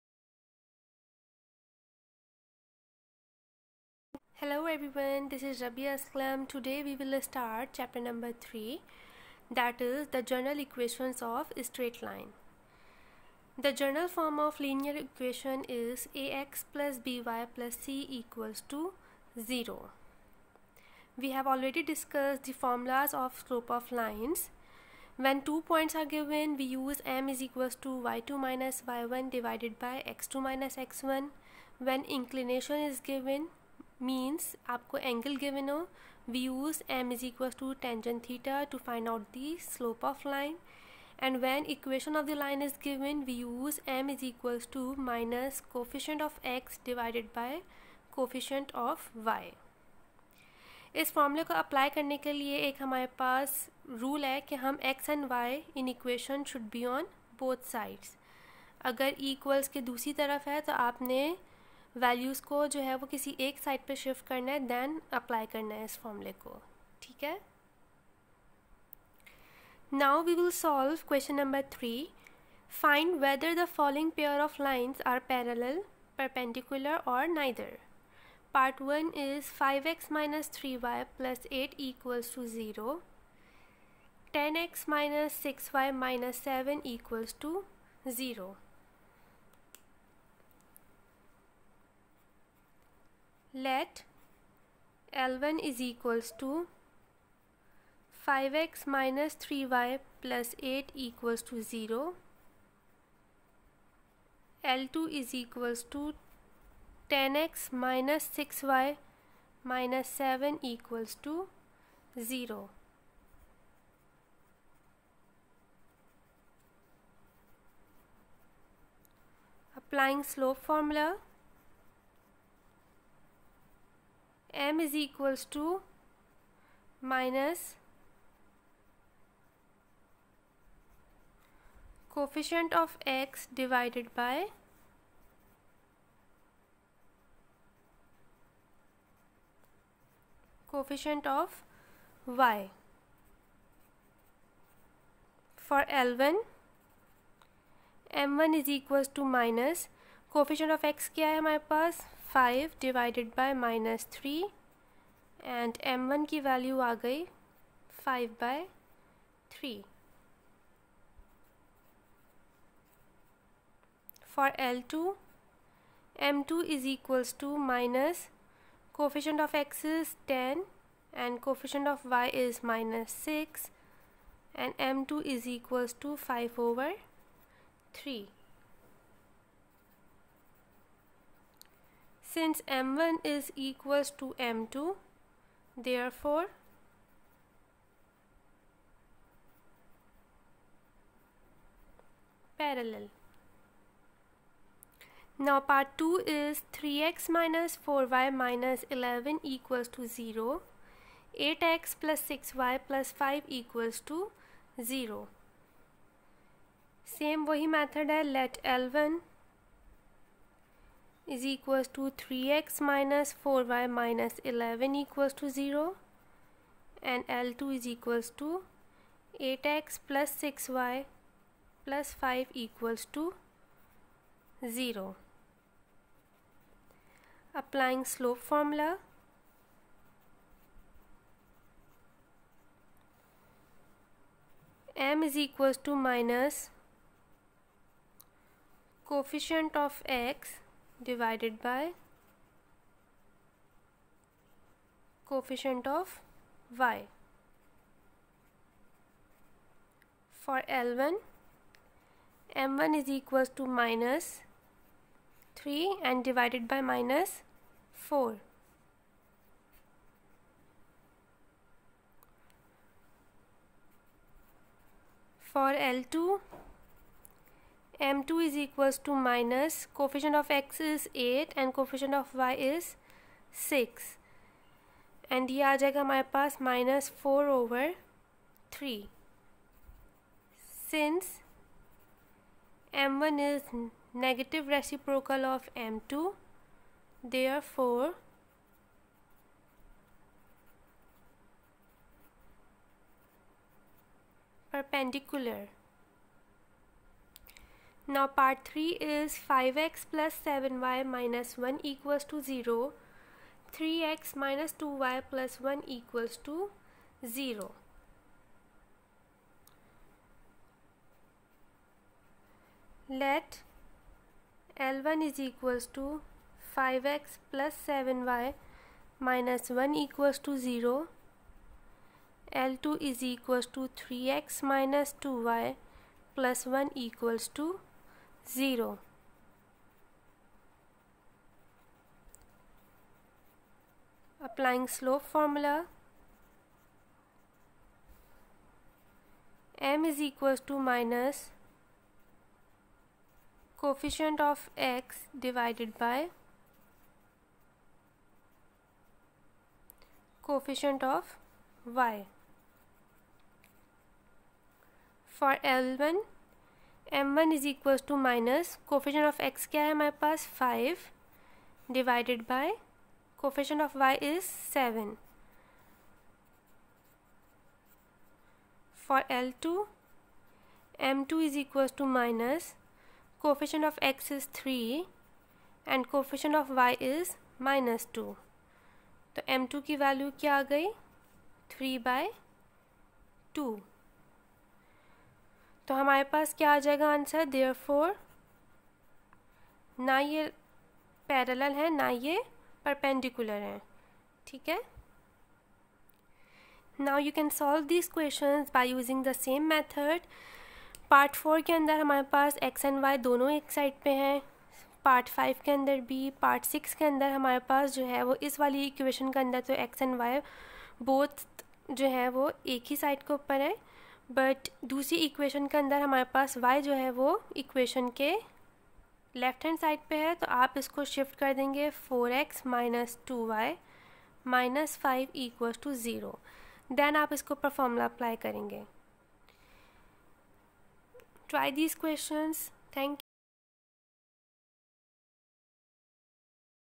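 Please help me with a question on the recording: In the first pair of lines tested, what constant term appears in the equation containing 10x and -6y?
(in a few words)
-7.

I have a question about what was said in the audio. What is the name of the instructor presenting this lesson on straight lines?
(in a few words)
Rabbia Aslam.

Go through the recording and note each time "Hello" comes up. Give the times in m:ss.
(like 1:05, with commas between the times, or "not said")
0:04.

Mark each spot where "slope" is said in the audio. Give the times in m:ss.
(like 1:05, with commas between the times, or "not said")
0:23, 2:00, 3:48, 5:34.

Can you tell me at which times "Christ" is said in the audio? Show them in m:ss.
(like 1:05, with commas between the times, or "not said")
not said.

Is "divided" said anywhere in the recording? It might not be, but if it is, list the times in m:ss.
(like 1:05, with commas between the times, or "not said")
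0:29, 2:13, 2:32, 4:01, 4:16, 5:45.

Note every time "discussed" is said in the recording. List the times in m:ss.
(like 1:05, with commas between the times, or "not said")
0:21.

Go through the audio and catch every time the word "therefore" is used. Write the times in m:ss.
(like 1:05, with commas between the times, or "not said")
3:05, 4:47.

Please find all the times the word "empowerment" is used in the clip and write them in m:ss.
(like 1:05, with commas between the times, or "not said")
not said.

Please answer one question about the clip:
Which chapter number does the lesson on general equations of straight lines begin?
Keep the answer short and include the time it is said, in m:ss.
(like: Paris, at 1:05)
3, at 0:07.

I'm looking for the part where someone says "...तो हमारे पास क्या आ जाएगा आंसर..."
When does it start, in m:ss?
6:25.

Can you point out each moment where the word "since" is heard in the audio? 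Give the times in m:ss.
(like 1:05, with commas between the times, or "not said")
3:02, 4:40.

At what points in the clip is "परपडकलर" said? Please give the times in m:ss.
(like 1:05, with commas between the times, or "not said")
1:16, 6:32.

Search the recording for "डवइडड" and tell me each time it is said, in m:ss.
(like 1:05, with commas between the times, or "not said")
0:46, 6:01.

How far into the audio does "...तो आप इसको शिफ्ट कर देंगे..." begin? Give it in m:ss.
7:00.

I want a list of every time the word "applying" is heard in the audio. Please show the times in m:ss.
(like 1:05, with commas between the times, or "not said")
1:59, 3:47, 5:34.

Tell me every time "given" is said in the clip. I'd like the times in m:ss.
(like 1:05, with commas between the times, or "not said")
0:26, 0:33.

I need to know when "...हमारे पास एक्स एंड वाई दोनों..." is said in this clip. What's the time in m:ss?
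6:42.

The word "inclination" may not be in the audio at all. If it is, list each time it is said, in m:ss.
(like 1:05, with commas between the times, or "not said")
0:32.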